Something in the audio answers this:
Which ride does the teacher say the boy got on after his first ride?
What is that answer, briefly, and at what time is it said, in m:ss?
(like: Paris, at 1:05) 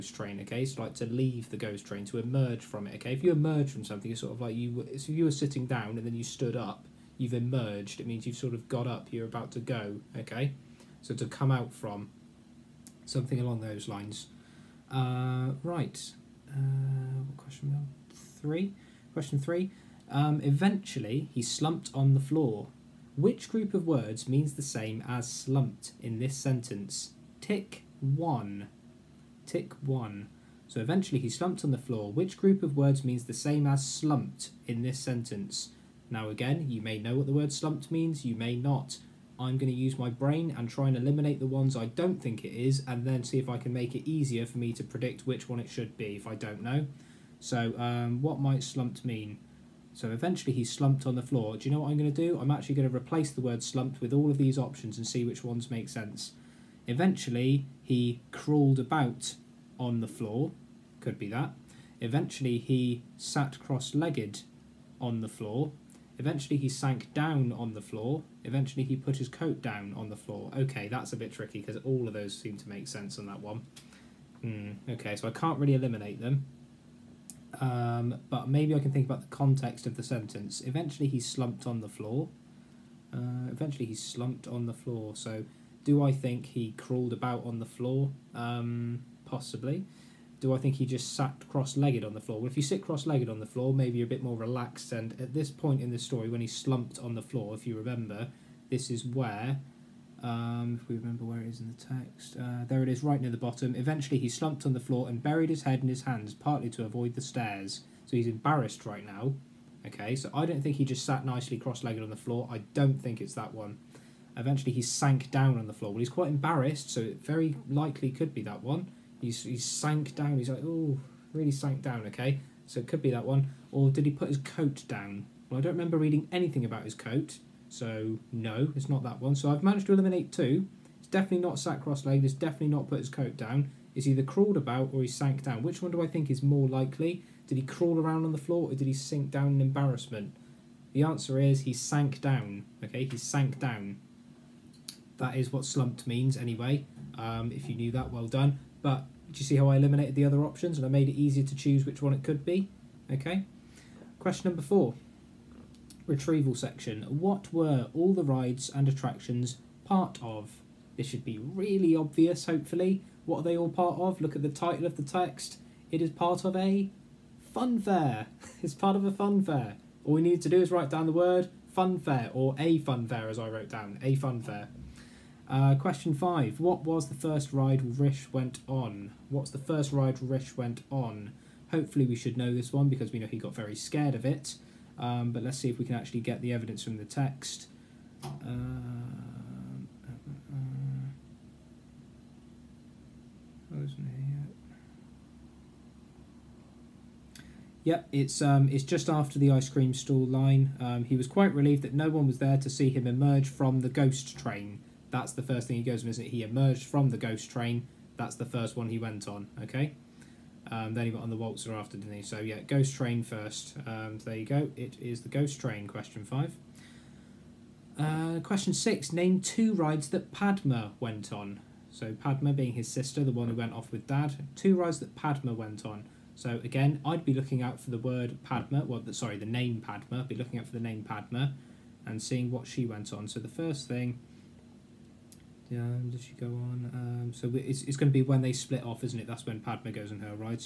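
the waltzer, at 3:31.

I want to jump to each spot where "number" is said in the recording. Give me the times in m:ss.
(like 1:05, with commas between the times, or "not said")
2:34.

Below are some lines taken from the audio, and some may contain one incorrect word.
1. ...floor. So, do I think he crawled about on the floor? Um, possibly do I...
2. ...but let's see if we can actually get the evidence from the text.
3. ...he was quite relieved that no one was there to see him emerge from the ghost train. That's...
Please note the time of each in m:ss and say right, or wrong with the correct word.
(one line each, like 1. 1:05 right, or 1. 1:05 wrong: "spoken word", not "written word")
1. 1:24 right
2. 3:05 right
3. 3:21 right.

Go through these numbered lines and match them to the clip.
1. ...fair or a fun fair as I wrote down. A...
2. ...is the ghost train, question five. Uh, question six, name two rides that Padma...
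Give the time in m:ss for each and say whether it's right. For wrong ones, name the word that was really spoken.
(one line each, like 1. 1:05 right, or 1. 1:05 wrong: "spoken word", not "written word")
1. 2:51 right
2. 3:34 right.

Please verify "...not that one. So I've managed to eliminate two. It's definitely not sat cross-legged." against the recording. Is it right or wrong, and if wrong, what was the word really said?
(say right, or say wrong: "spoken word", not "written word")
right.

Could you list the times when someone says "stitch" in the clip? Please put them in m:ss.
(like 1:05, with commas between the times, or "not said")
not said.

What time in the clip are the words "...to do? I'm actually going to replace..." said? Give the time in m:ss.
0:52.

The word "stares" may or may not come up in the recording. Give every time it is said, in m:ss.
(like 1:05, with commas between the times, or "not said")
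1:47.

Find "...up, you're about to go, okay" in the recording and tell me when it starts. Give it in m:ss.
0:08.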